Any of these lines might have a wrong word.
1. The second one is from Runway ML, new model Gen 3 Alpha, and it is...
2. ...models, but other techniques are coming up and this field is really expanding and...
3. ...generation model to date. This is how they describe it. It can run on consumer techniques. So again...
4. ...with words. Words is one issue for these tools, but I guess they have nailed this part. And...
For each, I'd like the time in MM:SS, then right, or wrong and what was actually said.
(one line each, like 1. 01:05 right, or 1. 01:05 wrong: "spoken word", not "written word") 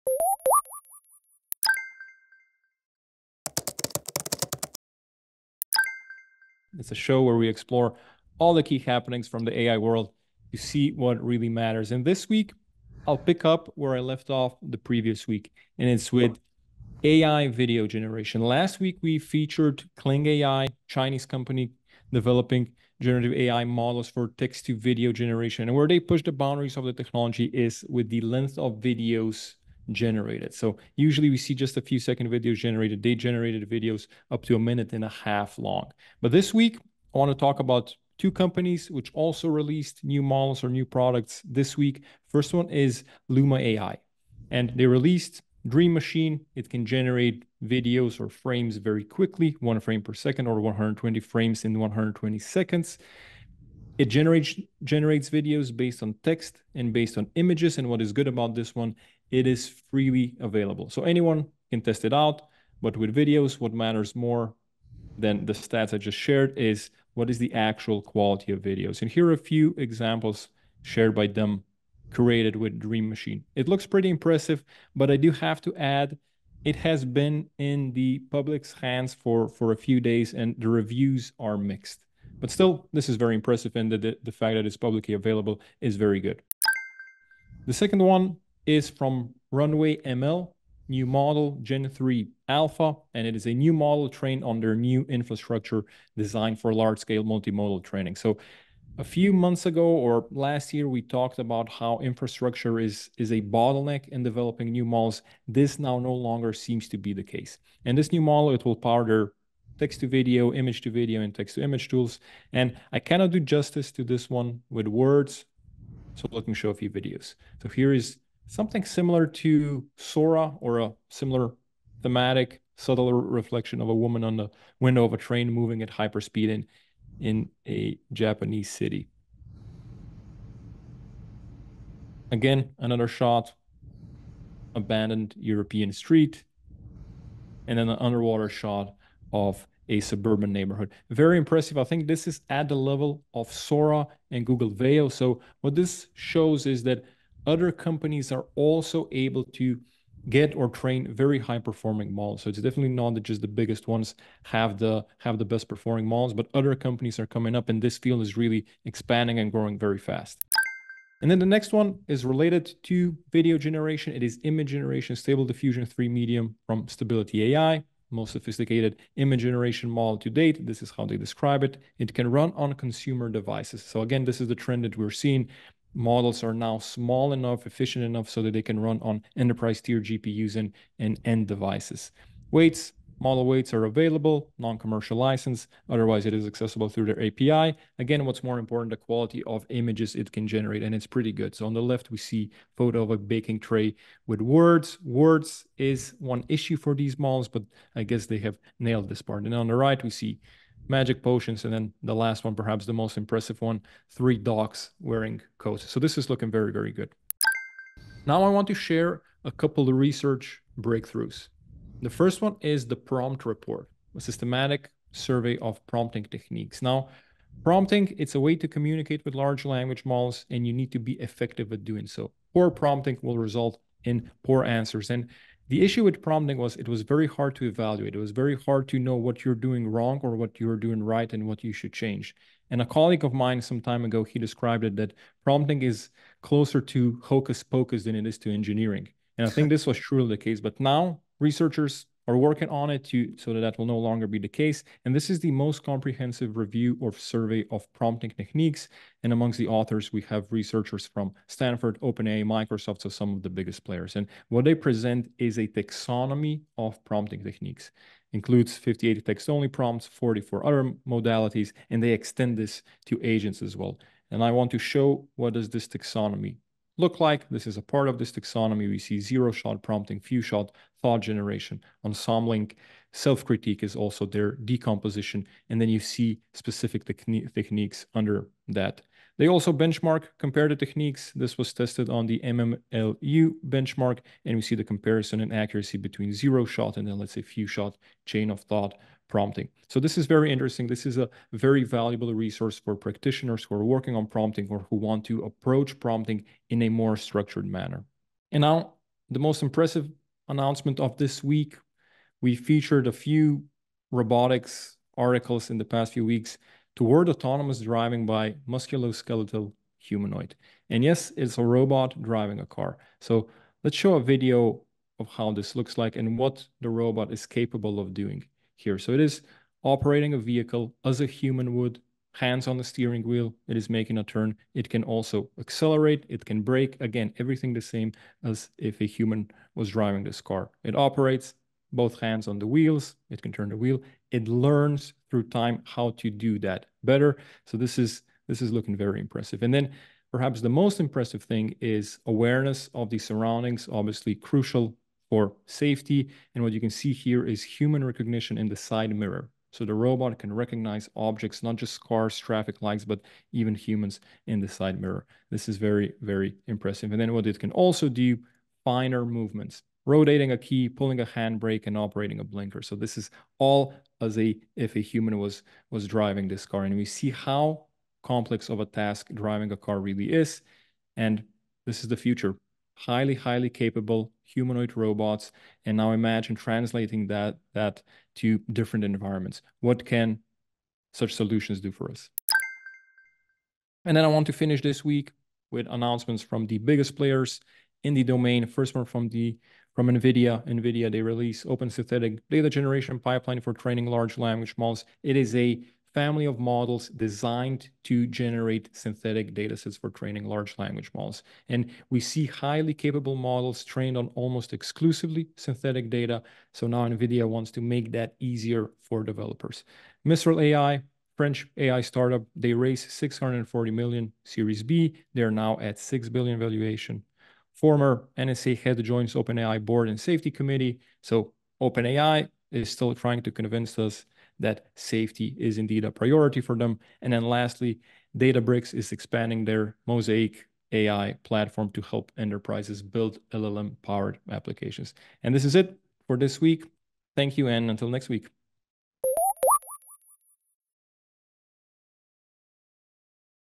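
1. 01:27 right
2. 02:36 wrong: "companies", not "techniques"
3. 02:49 wrong: "devices", not "techniques"
4. 03:14 wrong: "models", not "tools".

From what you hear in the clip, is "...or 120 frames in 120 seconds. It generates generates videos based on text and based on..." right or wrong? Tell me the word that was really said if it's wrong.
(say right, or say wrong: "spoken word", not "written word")
right.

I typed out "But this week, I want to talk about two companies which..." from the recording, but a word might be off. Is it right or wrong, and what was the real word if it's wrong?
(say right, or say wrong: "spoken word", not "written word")
right.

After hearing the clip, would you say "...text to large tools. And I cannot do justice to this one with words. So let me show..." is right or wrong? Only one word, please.
wrong.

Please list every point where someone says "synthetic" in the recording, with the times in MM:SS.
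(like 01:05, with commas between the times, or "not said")
06:31, 06:38, 06:45.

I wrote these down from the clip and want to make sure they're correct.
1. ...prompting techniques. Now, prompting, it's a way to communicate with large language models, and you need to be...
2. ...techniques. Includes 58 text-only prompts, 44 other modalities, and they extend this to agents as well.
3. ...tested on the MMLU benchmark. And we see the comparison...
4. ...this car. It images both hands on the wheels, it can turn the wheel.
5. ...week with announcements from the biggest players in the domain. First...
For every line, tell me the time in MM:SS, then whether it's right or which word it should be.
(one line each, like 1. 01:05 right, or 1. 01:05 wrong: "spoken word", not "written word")
1. 03:35 right
2. 04:17 right
3. 04:41 right
4. 05:30 wrong: "operates", not "images"
5. 06:25 right.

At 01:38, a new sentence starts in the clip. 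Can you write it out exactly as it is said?
So a few months ago or last year, we talked about how infrastructure is, is a bottleneck in developing new models.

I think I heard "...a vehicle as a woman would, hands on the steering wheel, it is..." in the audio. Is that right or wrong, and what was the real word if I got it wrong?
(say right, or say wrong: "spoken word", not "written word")
wrong: "human", not "woman".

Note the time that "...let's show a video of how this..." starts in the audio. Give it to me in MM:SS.
05:13.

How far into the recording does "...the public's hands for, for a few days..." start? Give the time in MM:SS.
01:17.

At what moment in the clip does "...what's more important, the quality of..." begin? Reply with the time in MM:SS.
03:08.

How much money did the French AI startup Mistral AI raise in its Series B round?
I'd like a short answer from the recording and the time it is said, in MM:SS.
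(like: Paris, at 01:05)
640 million, at 06:53.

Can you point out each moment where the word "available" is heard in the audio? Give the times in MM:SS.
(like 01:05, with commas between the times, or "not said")
01:00, 01:25, 03:03.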